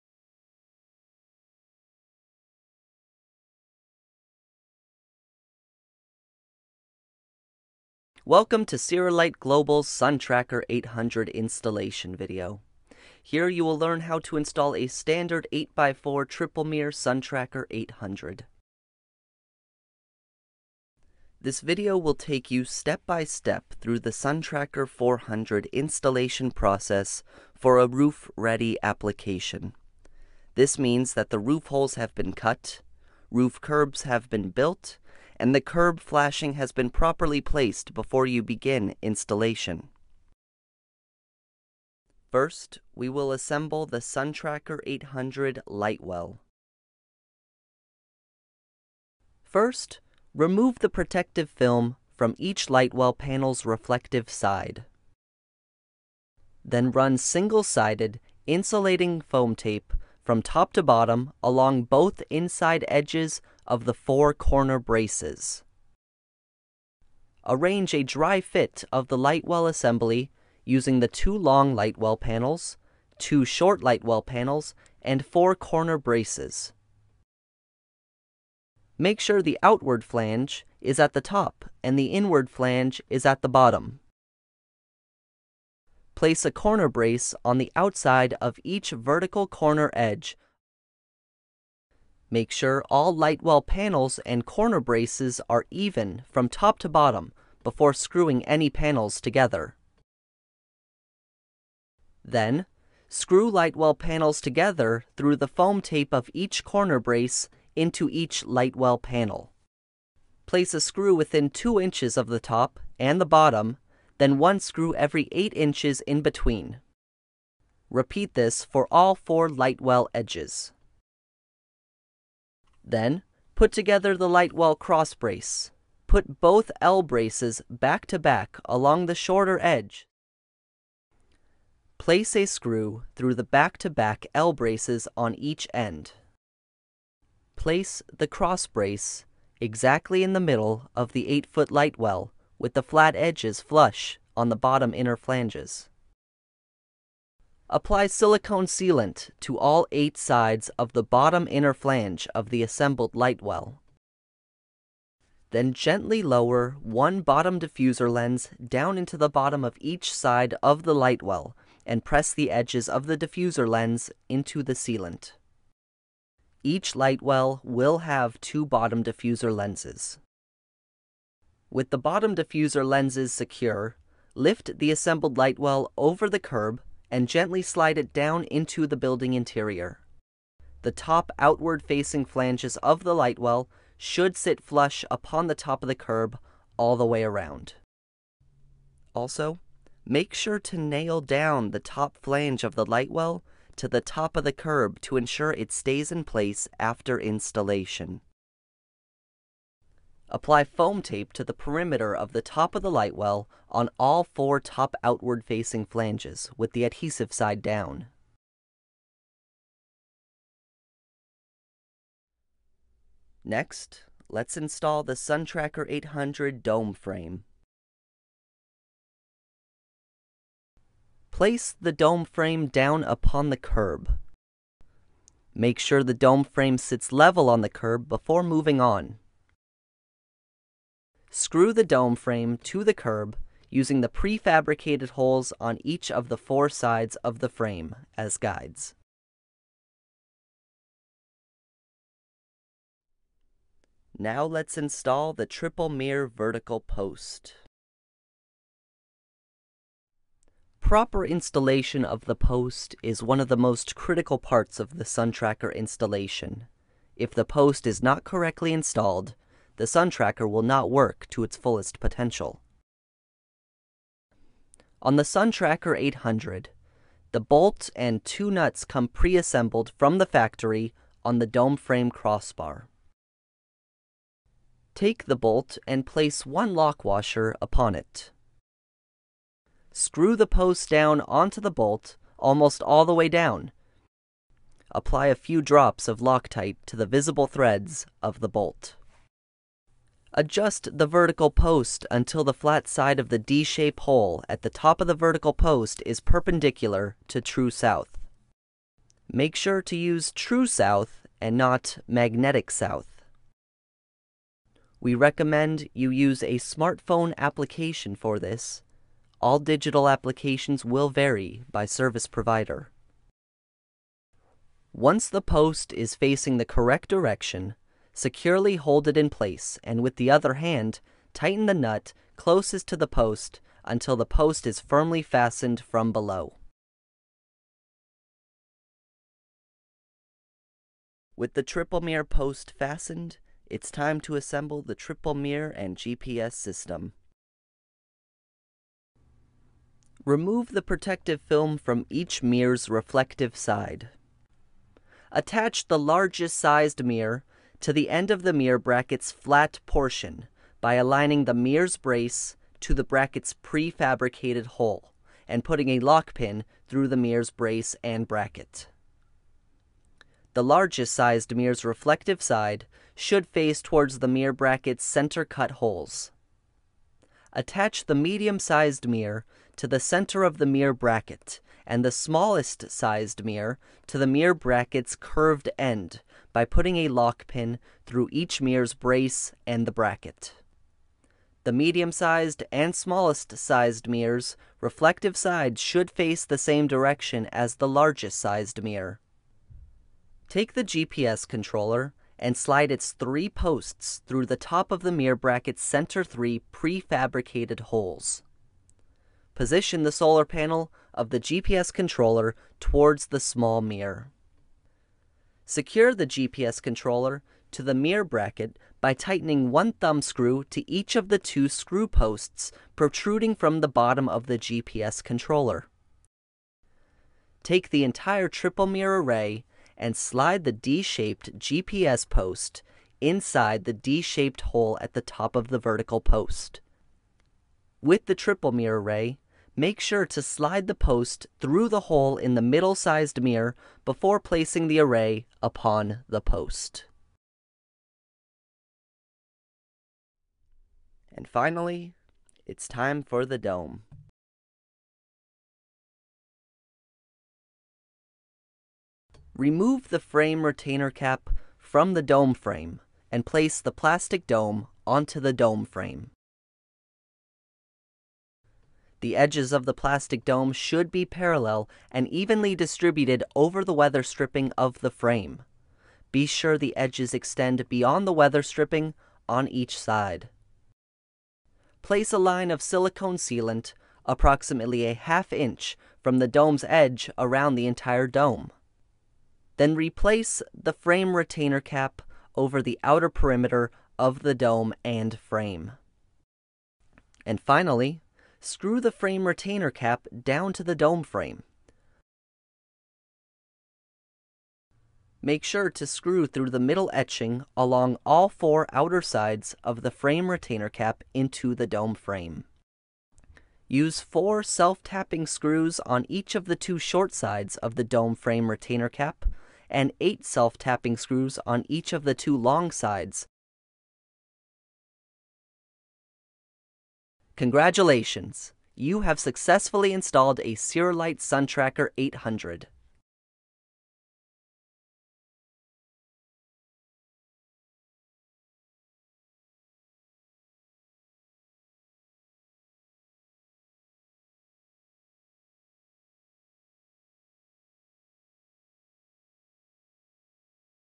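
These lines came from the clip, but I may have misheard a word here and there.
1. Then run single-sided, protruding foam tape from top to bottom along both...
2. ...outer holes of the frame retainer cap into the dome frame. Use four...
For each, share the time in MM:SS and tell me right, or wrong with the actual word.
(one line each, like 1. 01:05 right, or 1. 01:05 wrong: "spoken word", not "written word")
1. 00:56 wrong: "insulating", not "protruding"
2. 08:18 wrong: "sides", not "holes".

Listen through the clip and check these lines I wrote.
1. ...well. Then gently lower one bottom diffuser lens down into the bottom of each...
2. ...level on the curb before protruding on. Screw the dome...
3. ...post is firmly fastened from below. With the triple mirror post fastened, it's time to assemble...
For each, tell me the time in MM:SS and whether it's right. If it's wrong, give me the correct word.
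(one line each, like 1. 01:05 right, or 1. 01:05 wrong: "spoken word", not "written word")
1. 02:33 right
2. 03:47 wrong: "moving", not "protruding"
3. 05:24 right.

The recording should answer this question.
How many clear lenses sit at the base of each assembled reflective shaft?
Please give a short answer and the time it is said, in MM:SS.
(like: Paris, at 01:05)
2, at 02:48.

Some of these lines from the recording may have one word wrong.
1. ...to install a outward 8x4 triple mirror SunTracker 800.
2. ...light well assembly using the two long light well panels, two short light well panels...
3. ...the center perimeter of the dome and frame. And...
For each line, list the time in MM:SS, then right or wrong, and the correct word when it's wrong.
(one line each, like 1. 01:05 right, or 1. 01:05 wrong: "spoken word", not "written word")
1. 00:14 wrong: "standard", not "outward"
2. 01:09 right
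3. 08:02 wrong: "outer", not "center".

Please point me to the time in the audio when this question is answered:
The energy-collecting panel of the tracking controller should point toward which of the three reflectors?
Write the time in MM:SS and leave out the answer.
06:43.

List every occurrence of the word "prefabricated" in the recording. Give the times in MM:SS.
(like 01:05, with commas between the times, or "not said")
03:54, 05:53, 06:36.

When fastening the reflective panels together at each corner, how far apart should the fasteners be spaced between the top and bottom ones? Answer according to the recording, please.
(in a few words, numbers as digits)
8 inches.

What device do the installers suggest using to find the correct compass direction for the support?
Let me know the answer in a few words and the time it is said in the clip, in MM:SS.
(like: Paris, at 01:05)
Smartphone application, at 05:06.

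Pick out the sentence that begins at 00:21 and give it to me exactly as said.
This video will take you step by step through the SunTracker 400 installation process for a roof-ready application.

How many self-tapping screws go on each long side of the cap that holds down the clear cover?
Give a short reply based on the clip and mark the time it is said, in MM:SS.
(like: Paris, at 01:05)
8, at 08:30.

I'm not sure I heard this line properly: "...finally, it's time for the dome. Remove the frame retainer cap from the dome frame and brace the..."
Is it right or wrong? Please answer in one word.
wrong.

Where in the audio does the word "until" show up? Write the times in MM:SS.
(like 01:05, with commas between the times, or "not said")
04:52, 05:23.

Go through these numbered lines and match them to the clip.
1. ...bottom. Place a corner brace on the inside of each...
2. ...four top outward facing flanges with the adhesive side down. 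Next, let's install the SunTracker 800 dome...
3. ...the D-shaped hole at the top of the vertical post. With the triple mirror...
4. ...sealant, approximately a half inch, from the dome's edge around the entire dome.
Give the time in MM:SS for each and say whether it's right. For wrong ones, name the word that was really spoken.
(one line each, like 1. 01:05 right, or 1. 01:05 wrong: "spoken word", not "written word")
1. 01:23 wrong: "outside", not "inside"
2. 03:24 right
3. 07:03 right
4. 07:53 right.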